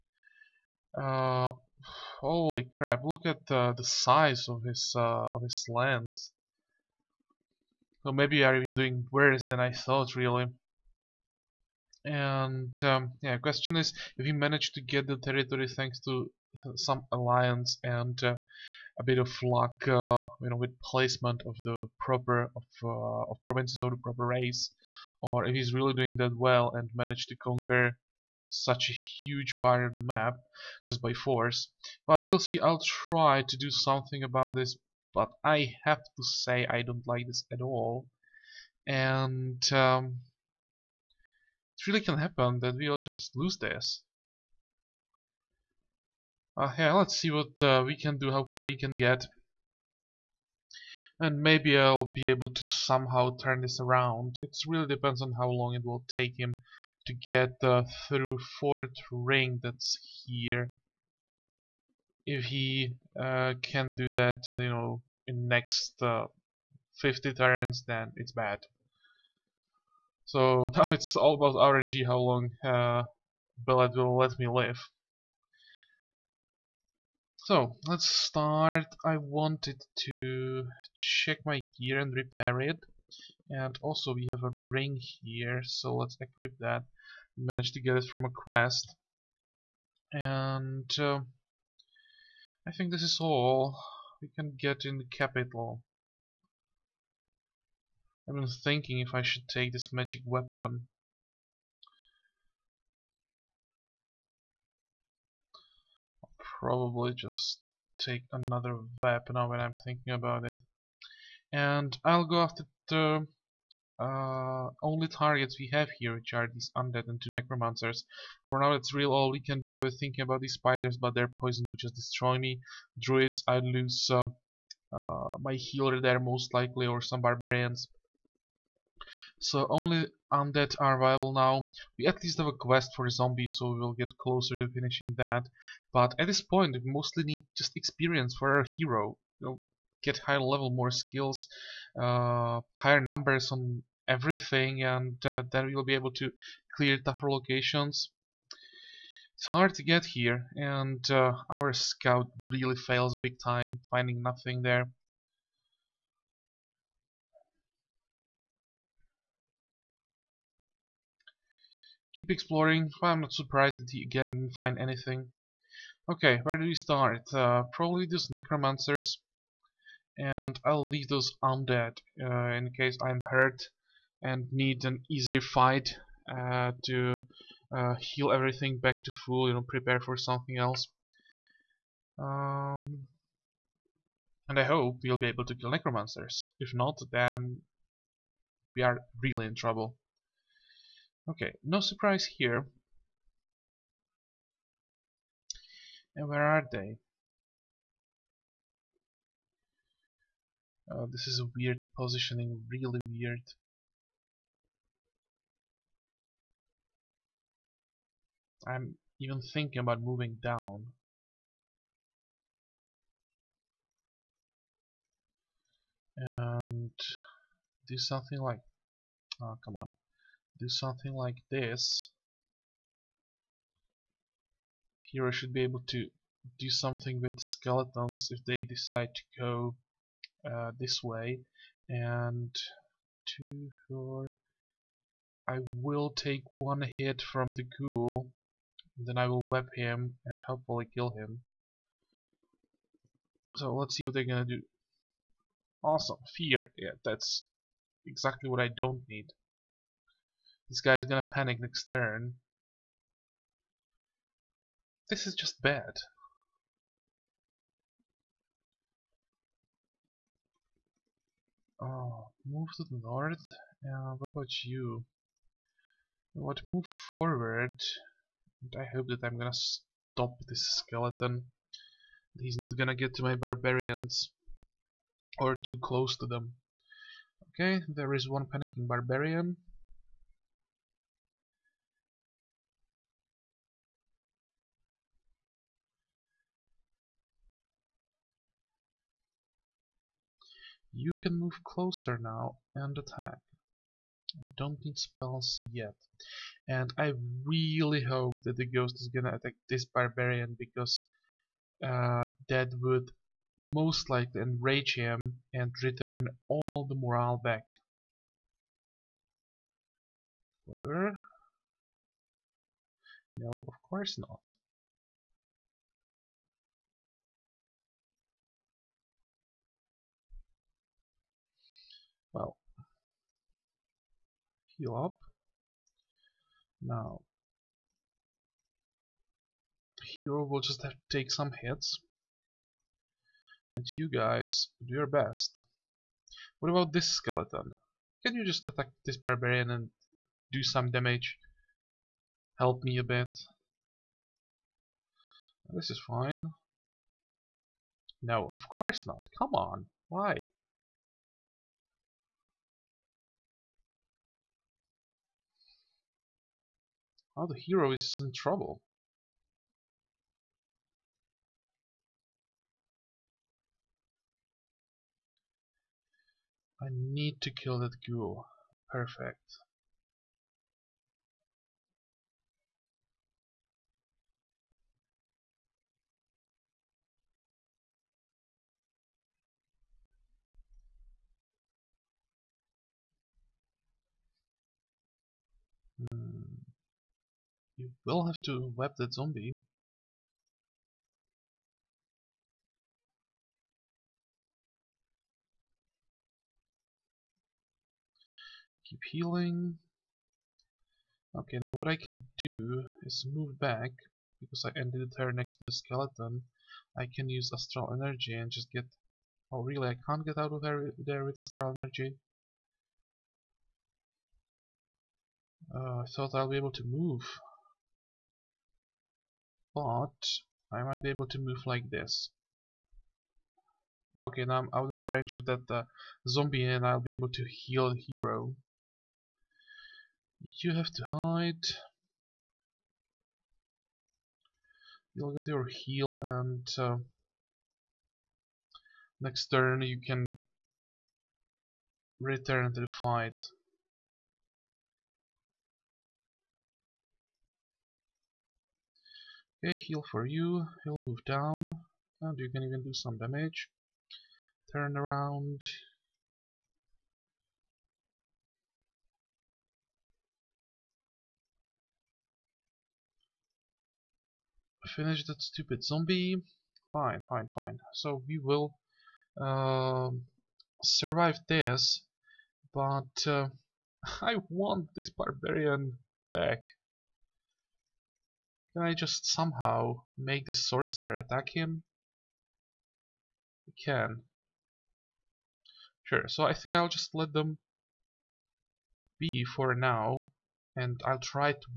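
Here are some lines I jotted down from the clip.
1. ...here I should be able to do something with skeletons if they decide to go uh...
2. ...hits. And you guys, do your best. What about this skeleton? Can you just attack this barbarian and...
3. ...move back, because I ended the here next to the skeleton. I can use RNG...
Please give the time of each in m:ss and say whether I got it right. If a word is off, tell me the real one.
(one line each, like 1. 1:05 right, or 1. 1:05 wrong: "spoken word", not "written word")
1. 3:45 right
2. 5:31 right
3. 6:43 wrong: "Astral", not "RNG".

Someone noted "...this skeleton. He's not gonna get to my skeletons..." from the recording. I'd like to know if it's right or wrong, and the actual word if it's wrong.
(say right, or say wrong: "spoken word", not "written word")
wrong: "barbarians", not "skeletons".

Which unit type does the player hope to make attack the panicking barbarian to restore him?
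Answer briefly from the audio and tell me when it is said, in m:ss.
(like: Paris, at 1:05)
sorcerer, at 8:00.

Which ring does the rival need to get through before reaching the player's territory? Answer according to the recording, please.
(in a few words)
fourth ring.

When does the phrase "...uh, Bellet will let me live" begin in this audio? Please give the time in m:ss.
1:12.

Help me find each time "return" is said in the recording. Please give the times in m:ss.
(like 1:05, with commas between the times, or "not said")
5:05, 7:22.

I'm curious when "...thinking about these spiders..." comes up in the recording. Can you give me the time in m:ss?
1:59.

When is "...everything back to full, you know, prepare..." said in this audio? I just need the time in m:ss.
2:58.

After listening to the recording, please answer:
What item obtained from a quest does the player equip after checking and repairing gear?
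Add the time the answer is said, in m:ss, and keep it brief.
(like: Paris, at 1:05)
a ring, at 1:24.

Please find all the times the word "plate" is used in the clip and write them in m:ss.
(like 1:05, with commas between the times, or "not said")
not said.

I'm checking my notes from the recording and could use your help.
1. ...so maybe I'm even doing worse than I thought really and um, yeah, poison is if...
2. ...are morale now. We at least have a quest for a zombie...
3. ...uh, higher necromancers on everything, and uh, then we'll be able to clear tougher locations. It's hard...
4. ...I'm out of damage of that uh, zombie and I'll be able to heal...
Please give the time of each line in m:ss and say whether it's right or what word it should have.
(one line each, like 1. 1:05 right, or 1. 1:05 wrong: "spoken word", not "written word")
1. 0:08 wrong: "question", not "poison"
2. 2:10 wrong: "viable", not "morale"
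3. 2:22 wrong: "numbers", not "necromancers"
4. 7:04 wrong: "range", not "damage".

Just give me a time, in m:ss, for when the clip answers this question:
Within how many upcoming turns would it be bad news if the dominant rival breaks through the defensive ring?
1:07.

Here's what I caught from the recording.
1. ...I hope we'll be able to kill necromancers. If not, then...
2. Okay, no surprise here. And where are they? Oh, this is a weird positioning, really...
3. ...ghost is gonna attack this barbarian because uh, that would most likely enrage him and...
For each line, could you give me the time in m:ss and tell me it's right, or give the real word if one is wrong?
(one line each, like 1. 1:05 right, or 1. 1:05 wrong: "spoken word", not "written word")
1. 3:04 right
2. 3:11 right
3. 4:58 right.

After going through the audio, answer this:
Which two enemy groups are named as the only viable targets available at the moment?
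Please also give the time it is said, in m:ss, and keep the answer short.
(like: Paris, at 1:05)
undead and two necromancers, at 1:56.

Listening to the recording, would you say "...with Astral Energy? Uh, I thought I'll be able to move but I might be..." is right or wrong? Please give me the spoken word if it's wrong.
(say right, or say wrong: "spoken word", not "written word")
right.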